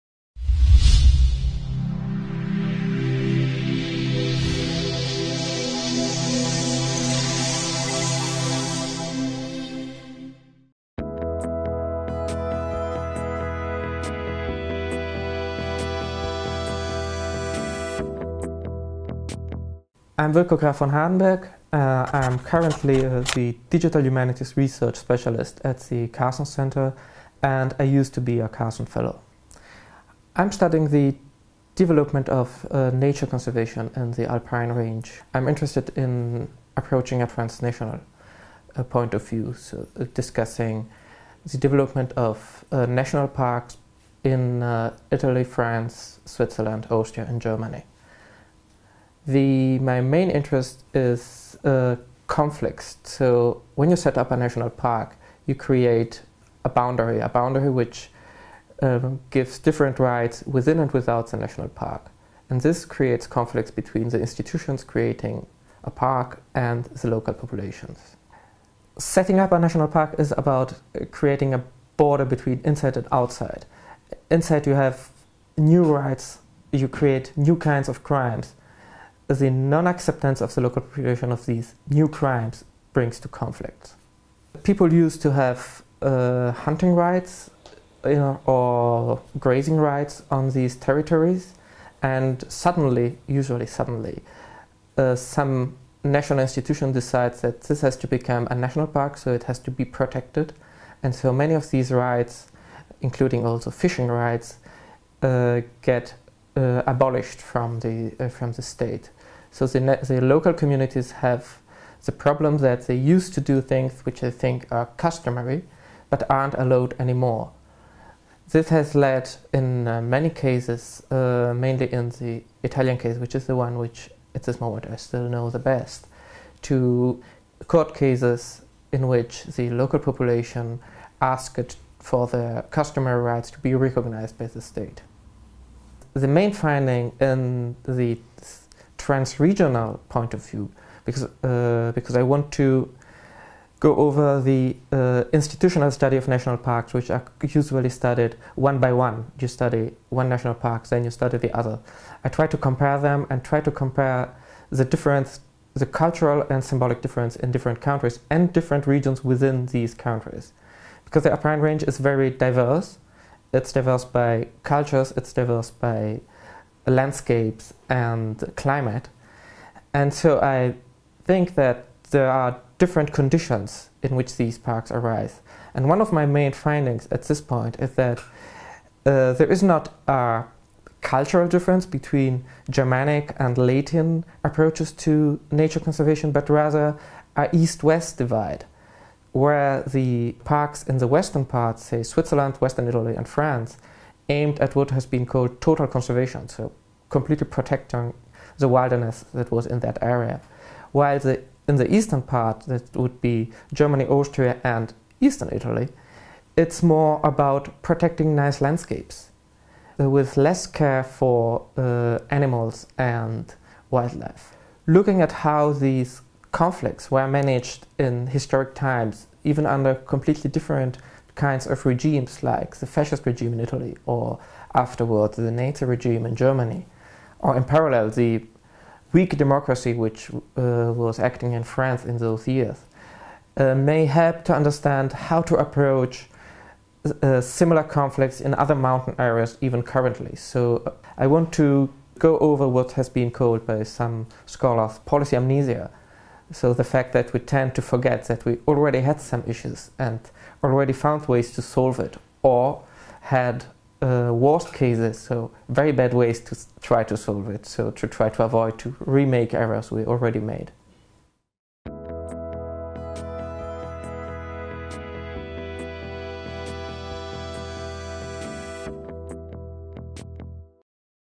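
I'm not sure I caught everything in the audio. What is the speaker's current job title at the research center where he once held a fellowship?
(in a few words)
Digital Humanities Research Specialist.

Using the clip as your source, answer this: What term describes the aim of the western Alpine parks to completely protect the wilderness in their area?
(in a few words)
total conservation.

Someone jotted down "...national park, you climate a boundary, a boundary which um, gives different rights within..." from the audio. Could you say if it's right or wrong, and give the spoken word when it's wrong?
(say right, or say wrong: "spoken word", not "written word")
wrong: "create", not "climate".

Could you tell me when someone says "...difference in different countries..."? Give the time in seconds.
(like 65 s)
157 s.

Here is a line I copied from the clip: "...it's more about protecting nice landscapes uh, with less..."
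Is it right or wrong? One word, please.
right.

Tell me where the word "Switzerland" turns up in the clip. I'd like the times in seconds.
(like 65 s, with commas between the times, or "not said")
46 s, 192 s.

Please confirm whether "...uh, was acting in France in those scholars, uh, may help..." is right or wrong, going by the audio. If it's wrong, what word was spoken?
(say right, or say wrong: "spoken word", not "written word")
wrong: "years", not "scholars".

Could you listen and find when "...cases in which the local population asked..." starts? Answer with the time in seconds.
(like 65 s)
127 s.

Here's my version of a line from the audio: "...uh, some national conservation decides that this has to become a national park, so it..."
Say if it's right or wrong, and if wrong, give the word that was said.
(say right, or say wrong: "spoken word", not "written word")
wrong: "institution", not "conservation".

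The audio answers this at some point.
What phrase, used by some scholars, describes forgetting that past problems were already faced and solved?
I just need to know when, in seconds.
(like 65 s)
244 s.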